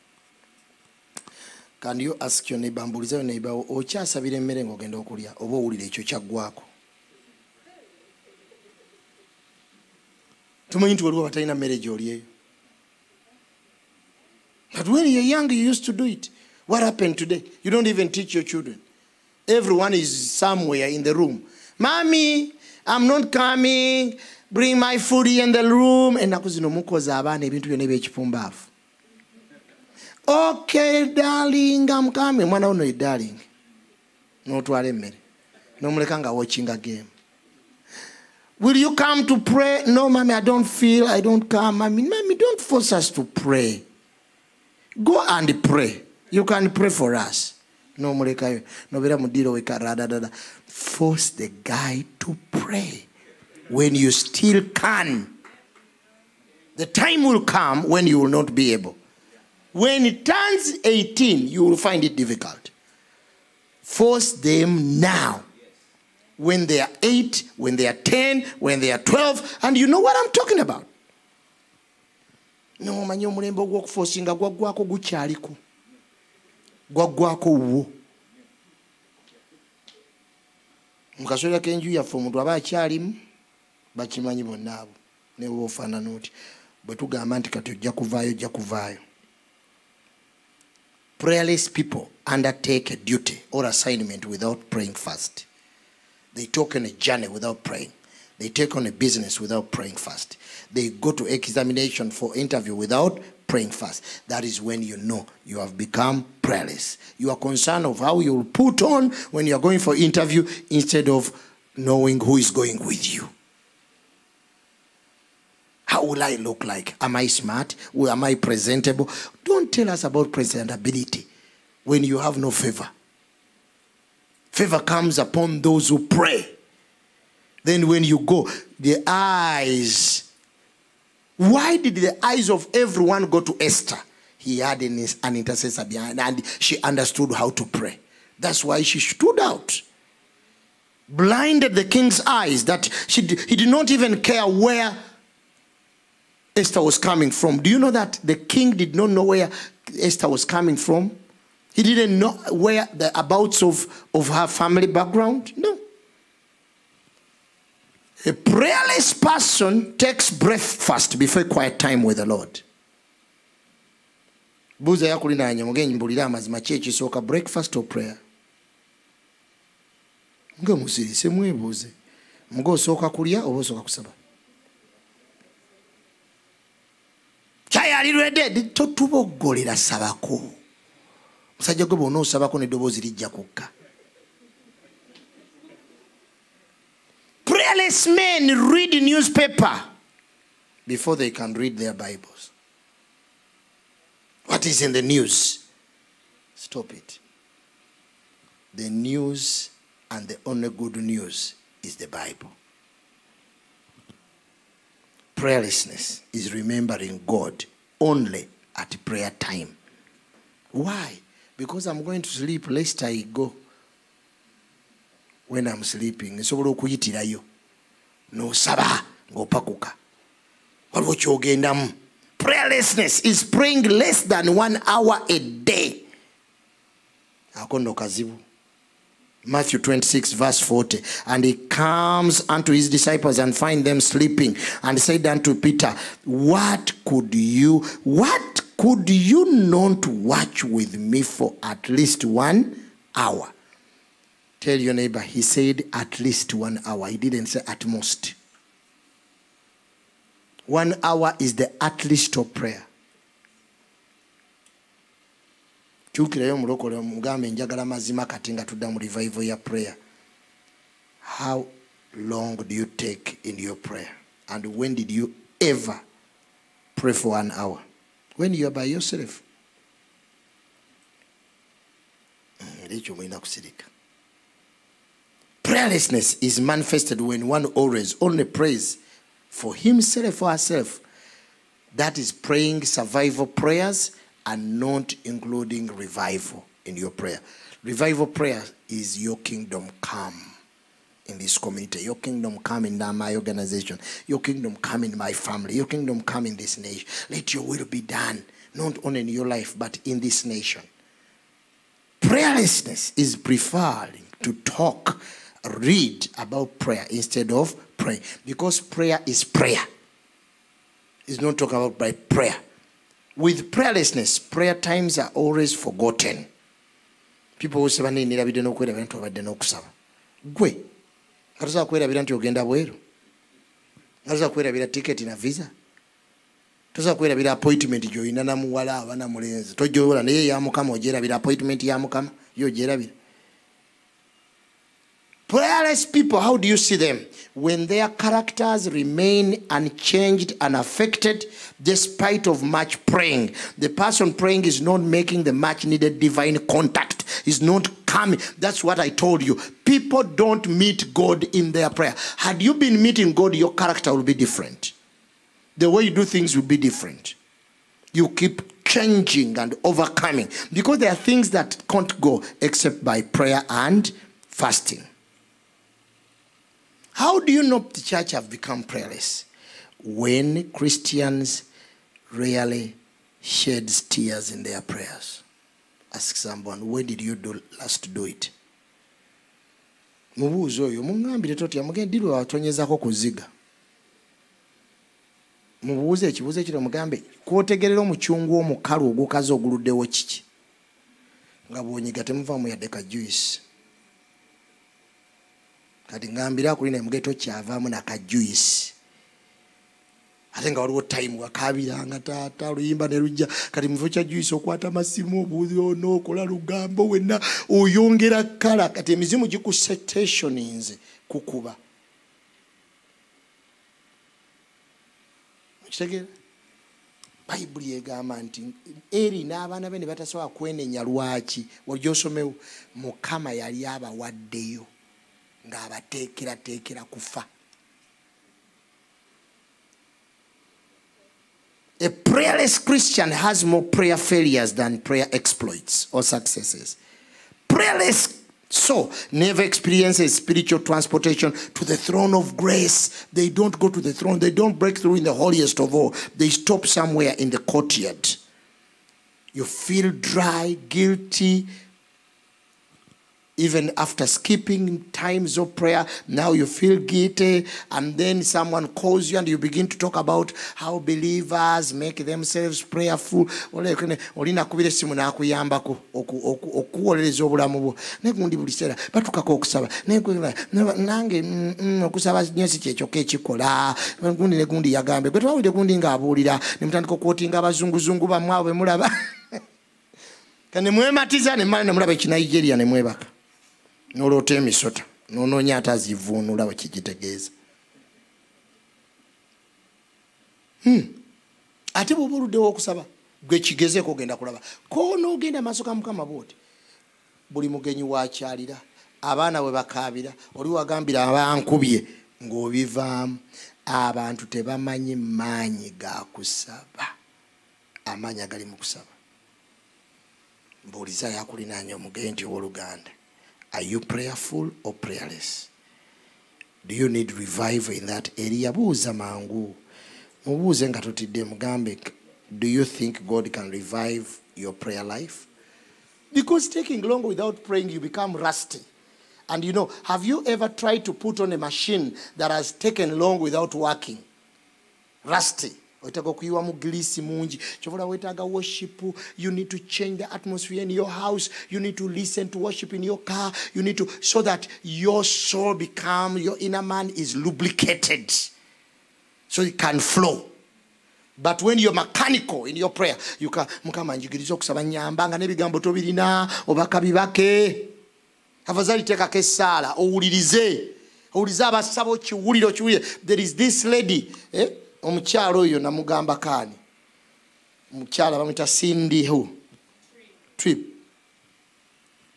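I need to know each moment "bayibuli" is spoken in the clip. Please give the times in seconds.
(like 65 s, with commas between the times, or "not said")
417 s.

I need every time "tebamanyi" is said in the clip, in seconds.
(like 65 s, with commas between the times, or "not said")
504 s.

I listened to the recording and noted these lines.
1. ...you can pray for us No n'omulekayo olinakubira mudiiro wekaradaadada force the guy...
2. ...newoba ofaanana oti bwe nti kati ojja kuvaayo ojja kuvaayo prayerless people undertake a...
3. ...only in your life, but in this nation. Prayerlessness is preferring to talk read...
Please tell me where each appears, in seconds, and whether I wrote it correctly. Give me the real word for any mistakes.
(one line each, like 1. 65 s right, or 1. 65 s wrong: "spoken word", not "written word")
1. 46 s wrong: "nobeera", not "olinakubira"
2. 85 s right
3. 299 s right.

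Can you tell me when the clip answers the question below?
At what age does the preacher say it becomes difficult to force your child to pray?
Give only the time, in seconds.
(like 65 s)
60 s.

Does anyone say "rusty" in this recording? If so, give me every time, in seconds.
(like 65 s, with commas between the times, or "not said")
528 s, 535 s.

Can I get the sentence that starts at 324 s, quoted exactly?
Nga tosobola ticket in a visa.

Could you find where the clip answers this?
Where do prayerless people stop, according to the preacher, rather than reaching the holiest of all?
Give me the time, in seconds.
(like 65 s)
447 s.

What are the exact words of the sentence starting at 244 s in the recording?
Tell your neighbor, he said at least one hour.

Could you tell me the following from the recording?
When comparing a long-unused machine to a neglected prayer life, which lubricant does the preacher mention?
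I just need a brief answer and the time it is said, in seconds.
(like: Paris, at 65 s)
grease, at 536 s.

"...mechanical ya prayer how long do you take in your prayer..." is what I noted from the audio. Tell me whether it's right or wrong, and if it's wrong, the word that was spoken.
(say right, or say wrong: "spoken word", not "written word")
wrong: "revival", not "mechanical".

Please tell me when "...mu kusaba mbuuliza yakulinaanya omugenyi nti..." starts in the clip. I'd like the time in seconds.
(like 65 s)
508 s.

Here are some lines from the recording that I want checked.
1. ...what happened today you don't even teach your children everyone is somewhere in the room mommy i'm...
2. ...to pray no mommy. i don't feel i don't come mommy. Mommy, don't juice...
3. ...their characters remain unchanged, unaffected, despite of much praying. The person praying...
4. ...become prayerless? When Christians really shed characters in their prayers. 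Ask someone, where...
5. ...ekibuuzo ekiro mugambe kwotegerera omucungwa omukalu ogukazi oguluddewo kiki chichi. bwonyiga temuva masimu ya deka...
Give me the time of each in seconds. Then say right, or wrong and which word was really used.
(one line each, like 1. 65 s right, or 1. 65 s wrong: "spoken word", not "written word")
1. 16 s right
2. 39 s wrong: "force", not "juice"
3. 337 s right
4. 368 s wrong: "tears", not "characters"
5. 386 s wrong: "mfamu", not "masimu".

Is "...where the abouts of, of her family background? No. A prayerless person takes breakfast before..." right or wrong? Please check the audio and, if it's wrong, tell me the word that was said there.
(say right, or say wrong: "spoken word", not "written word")
right.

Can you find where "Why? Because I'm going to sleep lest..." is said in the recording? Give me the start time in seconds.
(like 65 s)
210 s.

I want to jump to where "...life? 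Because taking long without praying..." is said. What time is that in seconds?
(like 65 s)
525 s.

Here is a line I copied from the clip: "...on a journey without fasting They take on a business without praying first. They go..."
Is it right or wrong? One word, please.
wrong.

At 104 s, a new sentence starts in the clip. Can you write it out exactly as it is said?
That is when you know you have become prayerless.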